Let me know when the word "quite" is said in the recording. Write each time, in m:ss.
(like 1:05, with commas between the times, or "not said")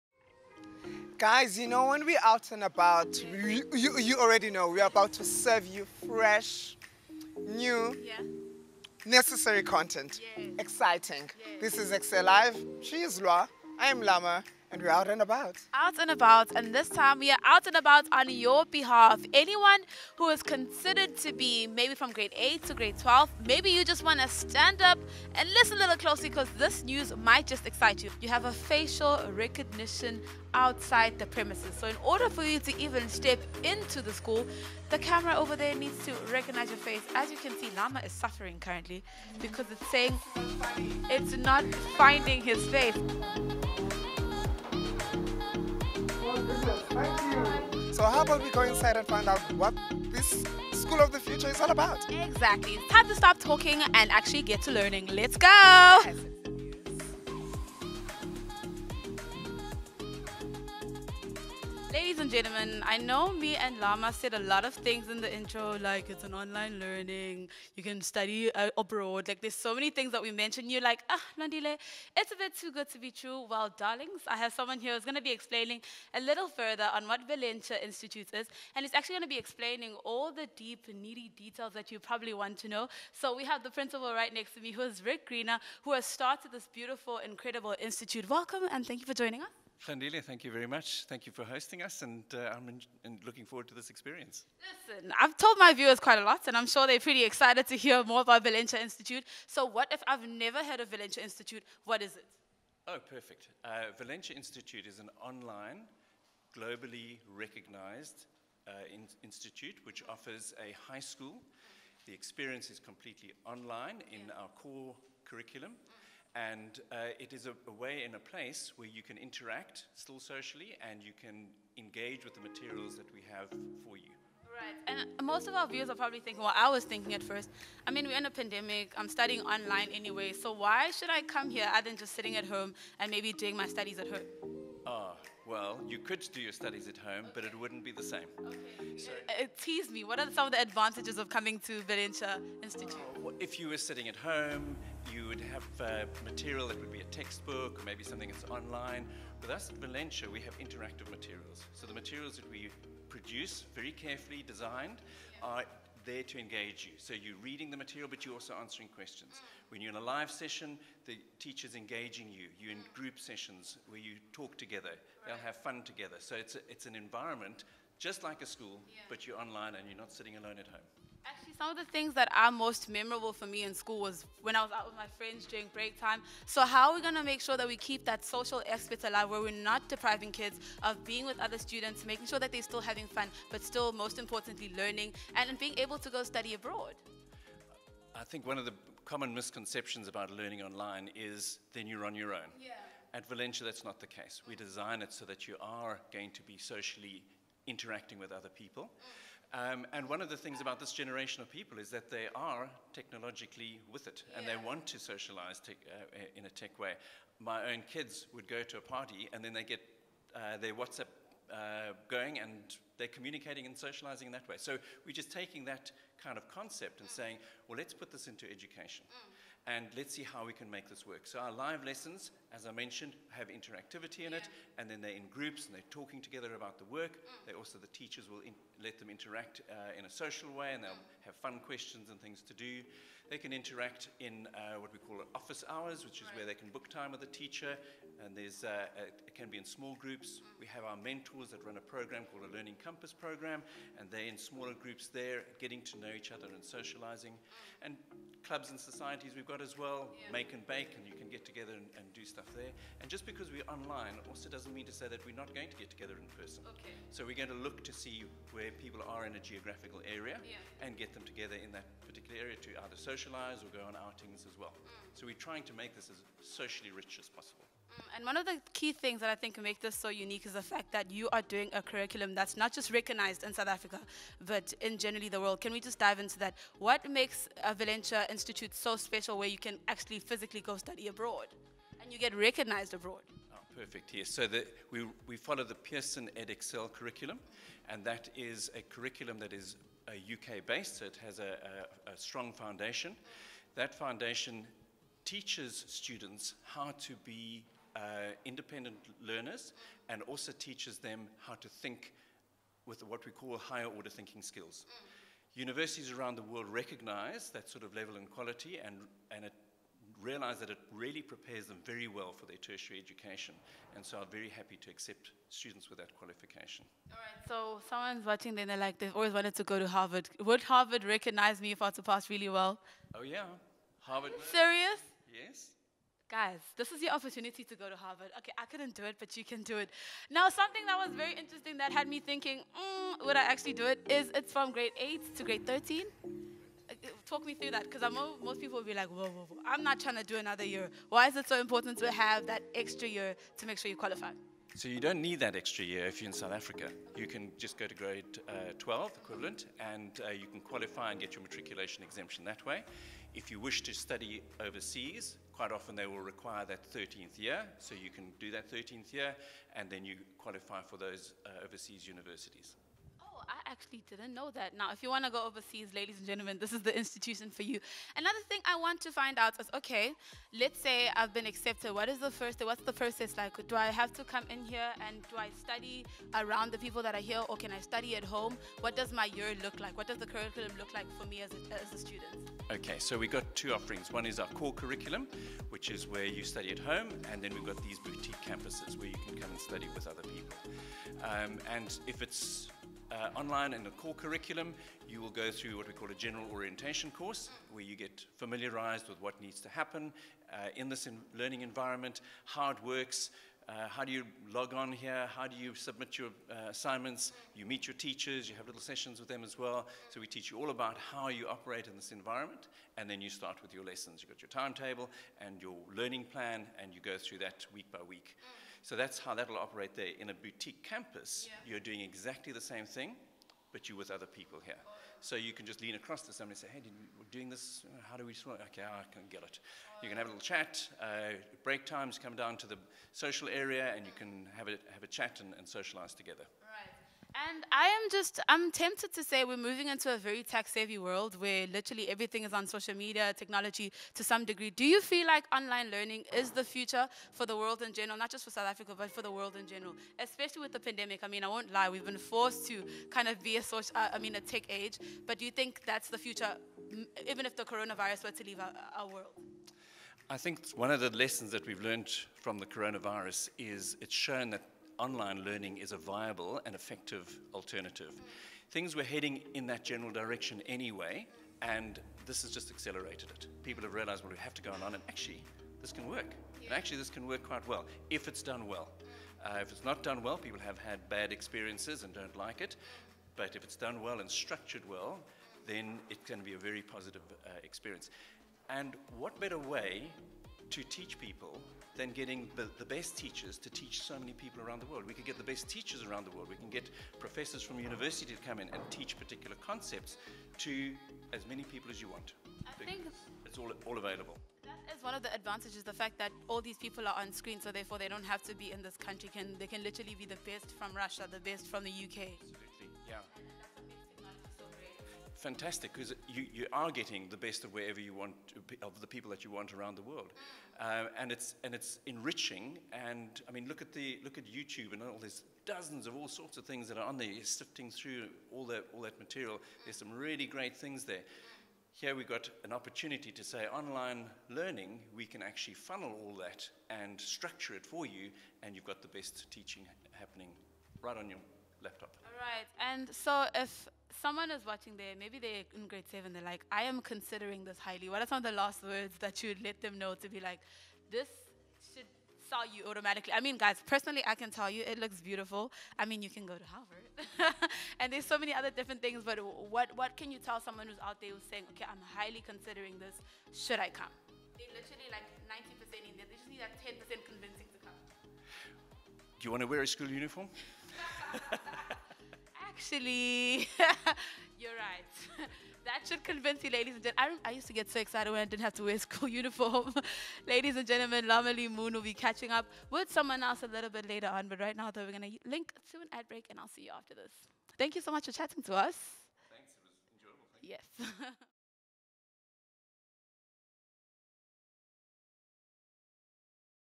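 1:35, 5:55, 7:57.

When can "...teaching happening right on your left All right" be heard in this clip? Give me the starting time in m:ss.
8:59.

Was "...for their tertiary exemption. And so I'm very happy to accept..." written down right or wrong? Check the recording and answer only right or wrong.
wrong.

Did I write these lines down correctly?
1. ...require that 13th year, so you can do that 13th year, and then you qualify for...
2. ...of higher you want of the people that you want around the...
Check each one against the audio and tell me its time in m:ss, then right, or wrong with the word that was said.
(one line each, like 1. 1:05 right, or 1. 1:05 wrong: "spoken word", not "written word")
1. 5:56 right
2. 8:37 wrong: "wherever", not "higher".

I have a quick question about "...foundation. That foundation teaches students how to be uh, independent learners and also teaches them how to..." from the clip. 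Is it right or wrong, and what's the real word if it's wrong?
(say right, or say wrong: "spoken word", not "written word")
right.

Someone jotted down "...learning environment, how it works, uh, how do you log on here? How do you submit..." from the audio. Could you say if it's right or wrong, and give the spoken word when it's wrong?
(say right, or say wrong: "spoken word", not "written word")
right.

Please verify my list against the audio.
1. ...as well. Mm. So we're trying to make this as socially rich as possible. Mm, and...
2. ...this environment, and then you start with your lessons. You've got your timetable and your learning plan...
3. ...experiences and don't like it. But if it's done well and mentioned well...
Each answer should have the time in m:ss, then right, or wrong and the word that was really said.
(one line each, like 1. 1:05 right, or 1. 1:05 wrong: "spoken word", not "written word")
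1. 4:24 right
2. 6:51 right
3. 8:01 wrong: "structured", not "mentioned".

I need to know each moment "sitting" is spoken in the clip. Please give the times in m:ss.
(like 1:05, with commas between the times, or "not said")
2:12, 2:23, 2:50.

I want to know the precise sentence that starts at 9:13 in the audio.
I mean, guys, personally, I can tell you it looks beautiful.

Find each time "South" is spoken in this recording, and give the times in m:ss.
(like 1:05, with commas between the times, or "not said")
4:33, 5:46, 7:28.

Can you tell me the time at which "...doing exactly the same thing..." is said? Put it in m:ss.
7:01.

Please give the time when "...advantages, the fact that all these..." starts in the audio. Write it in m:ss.
8:25.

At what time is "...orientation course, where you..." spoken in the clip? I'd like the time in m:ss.
6:36.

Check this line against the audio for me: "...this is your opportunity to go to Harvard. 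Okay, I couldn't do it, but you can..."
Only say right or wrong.
right.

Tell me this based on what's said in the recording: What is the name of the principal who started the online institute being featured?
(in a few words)
Rick Greener.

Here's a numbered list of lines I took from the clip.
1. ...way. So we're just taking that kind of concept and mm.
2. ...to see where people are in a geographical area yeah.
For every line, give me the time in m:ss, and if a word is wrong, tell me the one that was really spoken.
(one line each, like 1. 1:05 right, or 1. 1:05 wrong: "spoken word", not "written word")
1. 3:34 right
2. 4:17 right.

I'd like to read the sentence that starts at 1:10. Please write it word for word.
You're like, ah, Nandile, it's a bit too good to be true.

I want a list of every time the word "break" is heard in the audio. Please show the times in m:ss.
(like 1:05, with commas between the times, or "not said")
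2:55, 7:11, 9:46.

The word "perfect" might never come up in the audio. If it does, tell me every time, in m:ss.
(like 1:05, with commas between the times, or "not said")
1:43, 4:43.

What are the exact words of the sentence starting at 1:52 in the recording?
The experience is completely online in yeah.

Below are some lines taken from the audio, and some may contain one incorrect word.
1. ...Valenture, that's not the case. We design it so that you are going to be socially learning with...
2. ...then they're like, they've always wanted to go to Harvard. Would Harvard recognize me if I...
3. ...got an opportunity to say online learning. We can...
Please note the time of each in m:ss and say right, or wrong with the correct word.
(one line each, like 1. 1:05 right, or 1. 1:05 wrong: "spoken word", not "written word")
1. 3:13 wrong: "interacting", not "learning"
2. 5:18 right
3. 8:52 right.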